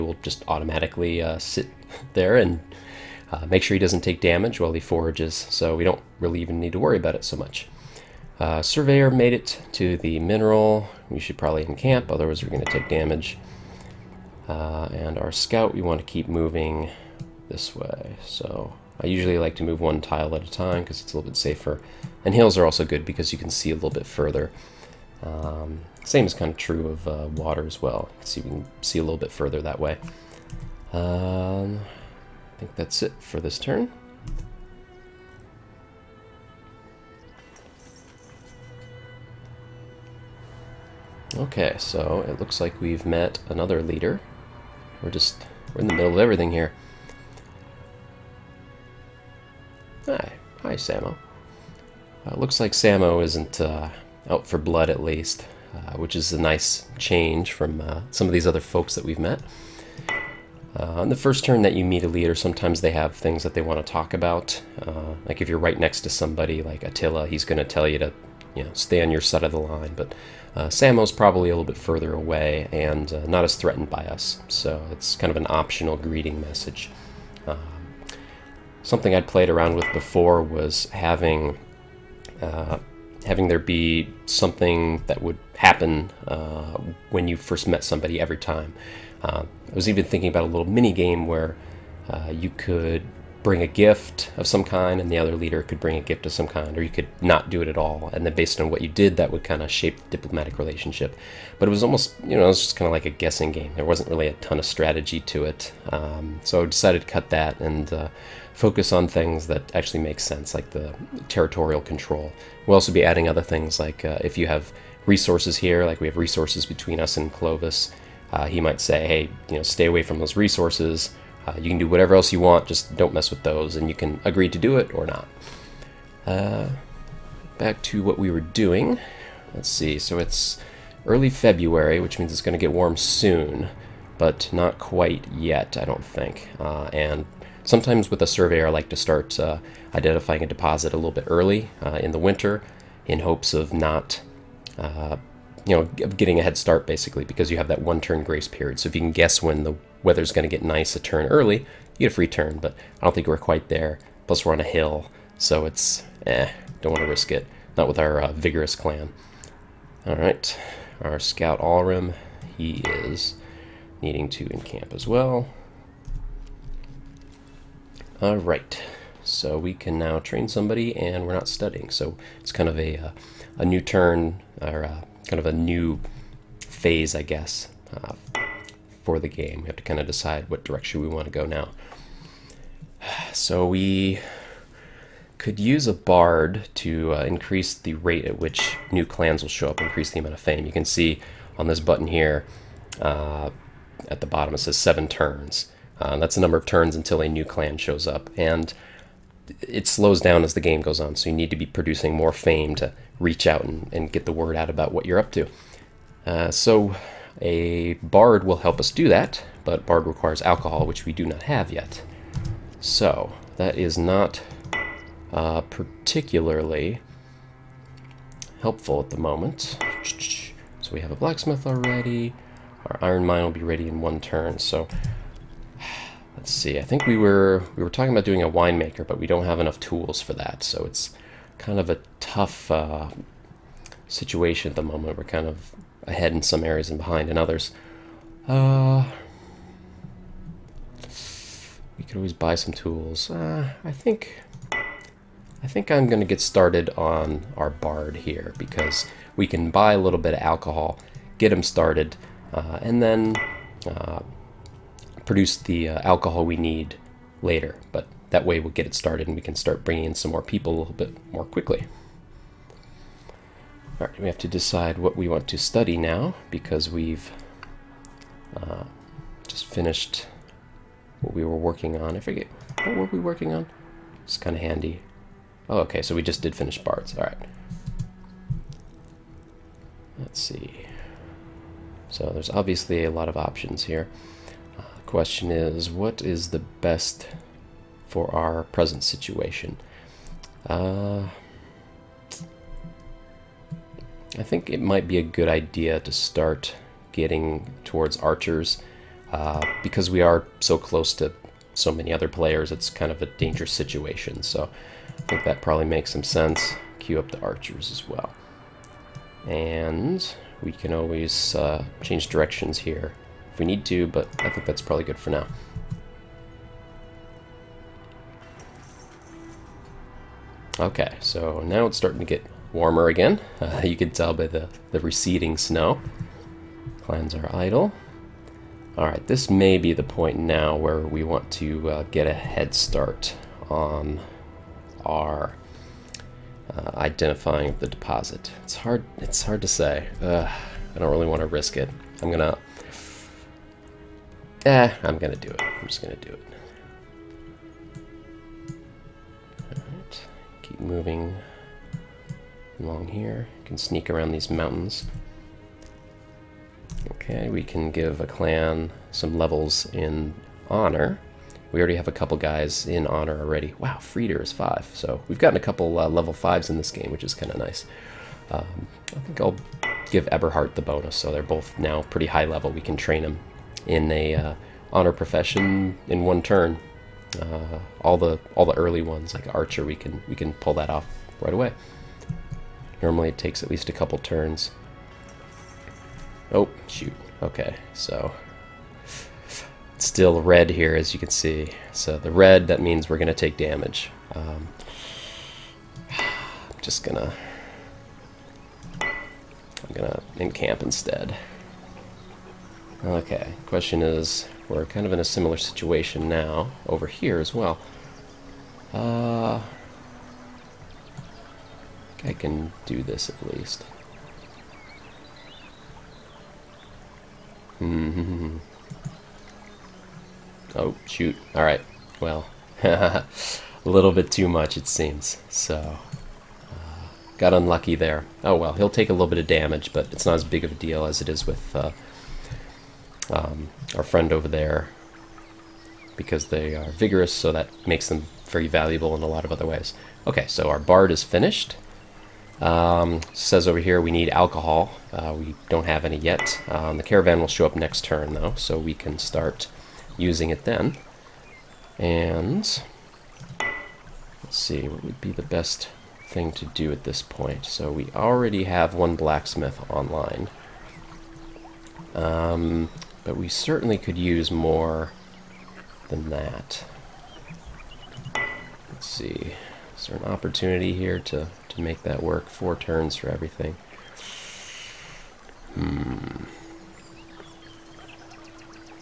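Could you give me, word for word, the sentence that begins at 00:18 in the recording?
So I usually like to move one tile at a time because it's a little bit safer.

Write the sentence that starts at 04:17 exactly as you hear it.
But that way we'll get it started and we can start bringing in some more people a little bit more quickly.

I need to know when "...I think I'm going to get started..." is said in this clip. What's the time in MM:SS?
04:05.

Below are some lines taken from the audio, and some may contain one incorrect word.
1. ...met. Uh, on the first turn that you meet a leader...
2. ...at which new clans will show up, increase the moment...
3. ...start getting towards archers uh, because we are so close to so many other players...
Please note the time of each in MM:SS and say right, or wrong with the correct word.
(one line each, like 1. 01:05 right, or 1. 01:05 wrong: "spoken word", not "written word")
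1. 00:59 right
2. 03:08 wrong: "amount", not "moment"
3. 04:56 right.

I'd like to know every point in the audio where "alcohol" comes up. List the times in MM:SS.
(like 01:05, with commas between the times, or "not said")
03:30, 04:10, 04:16, 07:24.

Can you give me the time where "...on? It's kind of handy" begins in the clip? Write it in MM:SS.
04:33.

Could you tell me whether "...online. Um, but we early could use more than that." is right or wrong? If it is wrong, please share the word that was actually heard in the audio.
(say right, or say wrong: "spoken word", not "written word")
wrong: "certainly", not "early".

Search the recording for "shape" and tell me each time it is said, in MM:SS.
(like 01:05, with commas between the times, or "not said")
01:39.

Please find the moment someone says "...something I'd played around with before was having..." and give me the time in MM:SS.
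01:18.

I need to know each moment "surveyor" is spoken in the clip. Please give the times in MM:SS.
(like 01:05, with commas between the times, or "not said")
00:08, 02:18.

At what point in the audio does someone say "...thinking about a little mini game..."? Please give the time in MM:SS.
01:30.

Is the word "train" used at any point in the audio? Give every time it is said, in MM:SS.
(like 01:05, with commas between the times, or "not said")
02:50, 06:12.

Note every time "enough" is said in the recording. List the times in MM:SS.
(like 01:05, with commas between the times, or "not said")
03:49.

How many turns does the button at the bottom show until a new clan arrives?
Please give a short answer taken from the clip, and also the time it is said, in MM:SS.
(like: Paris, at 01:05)
7, at 03:14.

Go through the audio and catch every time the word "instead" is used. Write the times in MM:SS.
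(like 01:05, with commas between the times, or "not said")
06:40.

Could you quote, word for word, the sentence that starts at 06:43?
Okay, question is, we're kind of in a similar situation now, over here as well.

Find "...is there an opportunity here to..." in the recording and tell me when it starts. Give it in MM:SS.
07:49.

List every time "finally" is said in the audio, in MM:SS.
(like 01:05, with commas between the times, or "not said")
not said.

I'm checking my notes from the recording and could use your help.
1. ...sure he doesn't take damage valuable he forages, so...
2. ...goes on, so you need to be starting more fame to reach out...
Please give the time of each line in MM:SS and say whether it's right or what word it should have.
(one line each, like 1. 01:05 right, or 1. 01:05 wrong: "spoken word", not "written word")
1. 00:03 wrong: "while", not "valuable"
2. 03:20 wrong: "producing", not "starting".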